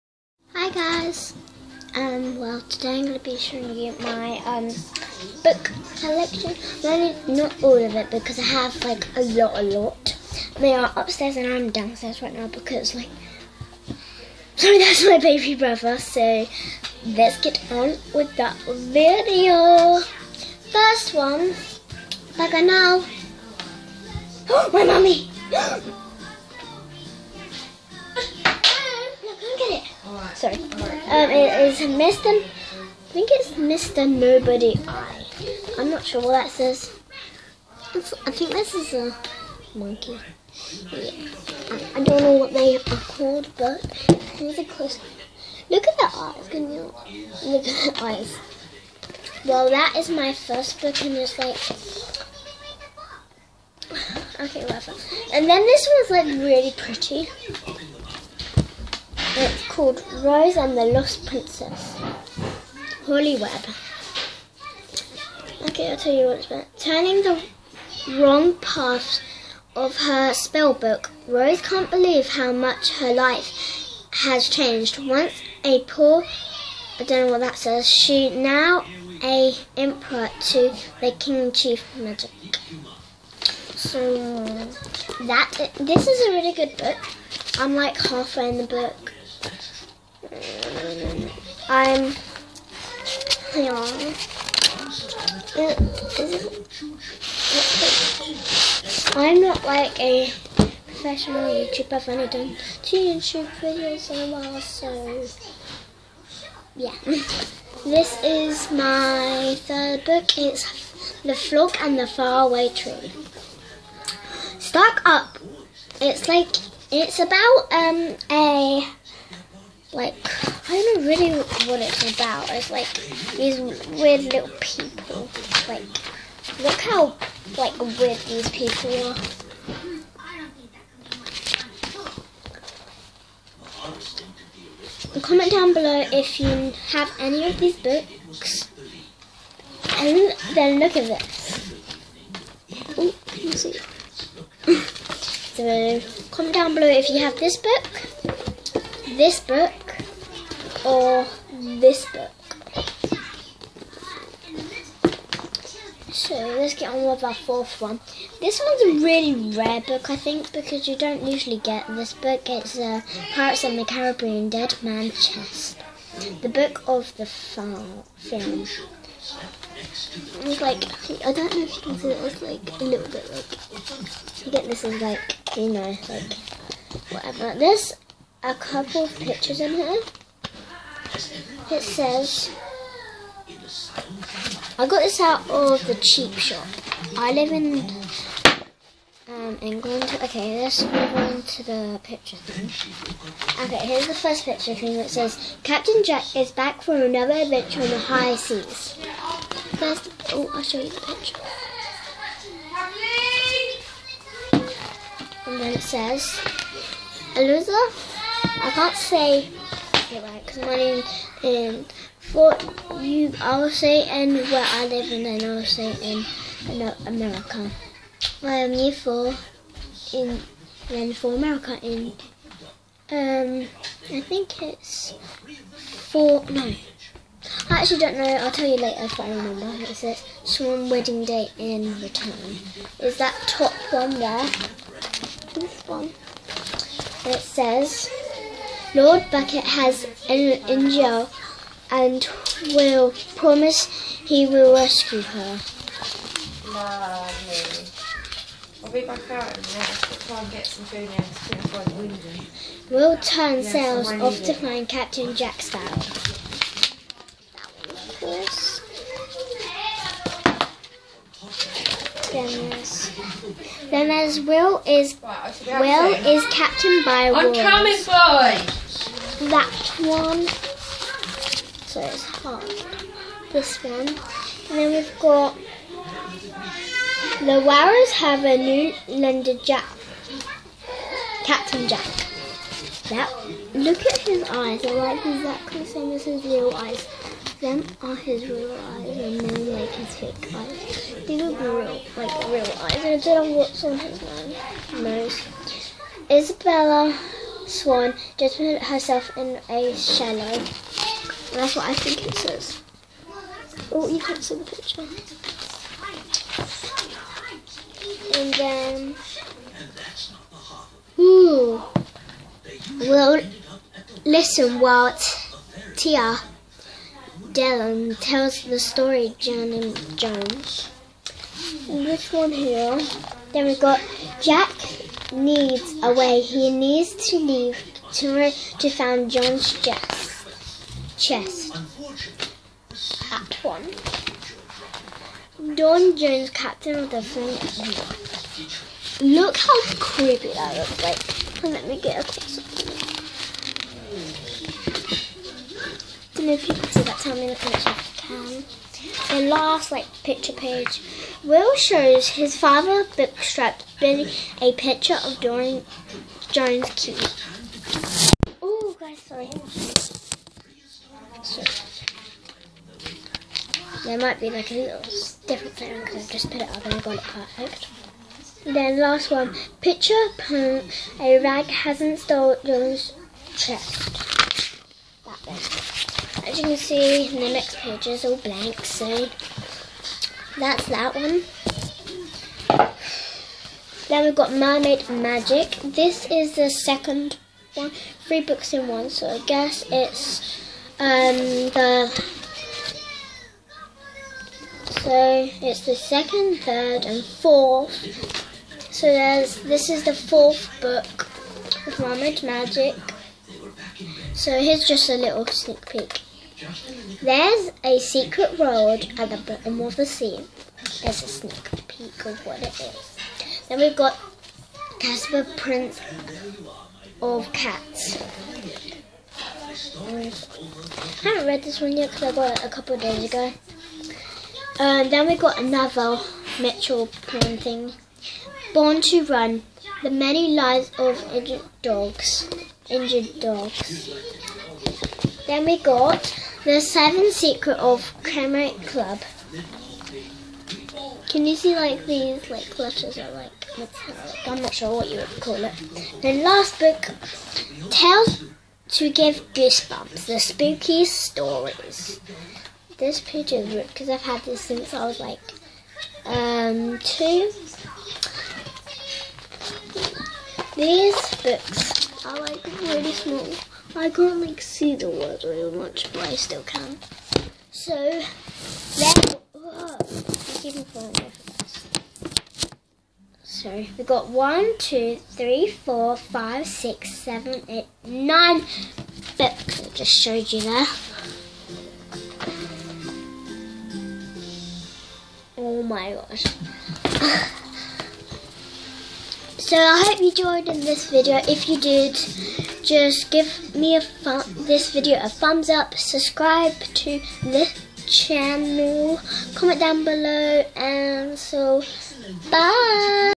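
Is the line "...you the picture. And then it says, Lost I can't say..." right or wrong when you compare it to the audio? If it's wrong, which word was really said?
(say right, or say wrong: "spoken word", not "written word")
wrong: "Elizabeth", not "Lost".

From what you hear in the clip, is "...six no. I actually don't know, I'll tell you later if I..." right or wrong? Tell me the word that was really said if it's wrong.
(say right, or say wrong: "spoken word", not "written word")
wrong: "four", not "six".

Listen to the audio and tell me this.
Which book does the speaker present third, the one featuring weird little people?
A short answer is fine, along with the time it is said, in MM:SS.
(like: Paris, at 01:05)
The Folk and the Faraway Tree, at 01:51.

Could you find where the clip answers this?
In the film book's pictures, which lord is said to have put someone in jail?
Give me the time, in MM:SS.
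03:58.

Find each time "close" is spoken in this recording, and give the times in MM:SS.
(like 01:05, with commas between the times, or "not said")
00:44, 05:42.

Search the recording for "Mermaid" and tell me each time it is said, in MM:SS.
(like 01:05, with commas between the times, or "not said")
06:24, 06:41.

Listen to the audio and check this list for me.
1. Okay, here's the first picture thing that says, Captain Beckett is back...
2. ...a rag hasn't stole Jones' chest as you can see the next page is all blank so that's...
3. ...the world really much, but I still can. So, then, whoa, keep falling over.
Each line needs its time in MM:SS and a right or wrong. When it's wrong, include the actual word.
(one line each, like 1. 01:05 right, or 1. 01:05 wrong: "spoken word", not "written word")
1. 03:13 wrong: "Jack", not "Beckett"
2. 06:11 right
3. 07:44 right.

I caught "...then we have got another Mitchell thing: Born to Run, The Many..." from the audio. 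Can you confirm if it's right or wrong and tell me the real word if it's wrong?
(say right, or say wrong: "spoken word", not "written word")
right.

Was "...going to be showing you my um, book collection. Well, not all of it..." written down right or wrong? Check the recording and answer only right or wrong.
right.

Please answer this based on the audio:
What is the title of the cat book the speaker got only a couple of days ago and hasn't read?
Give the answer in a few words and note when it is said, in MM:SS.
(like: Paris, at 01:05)
Casper Prince of Cats, at 06:54.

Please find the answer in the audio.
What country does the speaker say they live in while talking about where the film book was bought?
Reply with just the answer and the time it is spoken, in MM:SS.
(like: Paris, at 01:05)
England, at 03:09.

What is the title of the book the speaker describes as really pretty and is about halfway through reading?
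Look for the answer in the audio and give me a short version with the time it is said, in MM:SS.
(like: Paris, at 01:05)
Rose and the Lost Princess, at 01:00.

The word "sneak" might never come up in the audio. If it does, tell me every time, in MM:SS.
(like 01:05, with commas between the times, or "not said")
06:45, 06:51.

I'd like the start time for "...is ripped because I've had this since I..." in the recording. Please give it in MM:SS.
07:33.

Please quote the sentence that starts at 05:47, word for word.
Tell me in the comments if you can the last like picture page.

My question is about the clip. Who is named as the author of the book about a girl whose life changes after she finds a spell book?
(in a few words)
Holly Webb.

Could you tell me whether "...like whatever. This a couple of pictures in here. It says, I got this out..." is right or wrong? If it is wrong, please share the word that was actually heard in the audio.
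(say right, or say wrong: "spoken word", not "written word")
right.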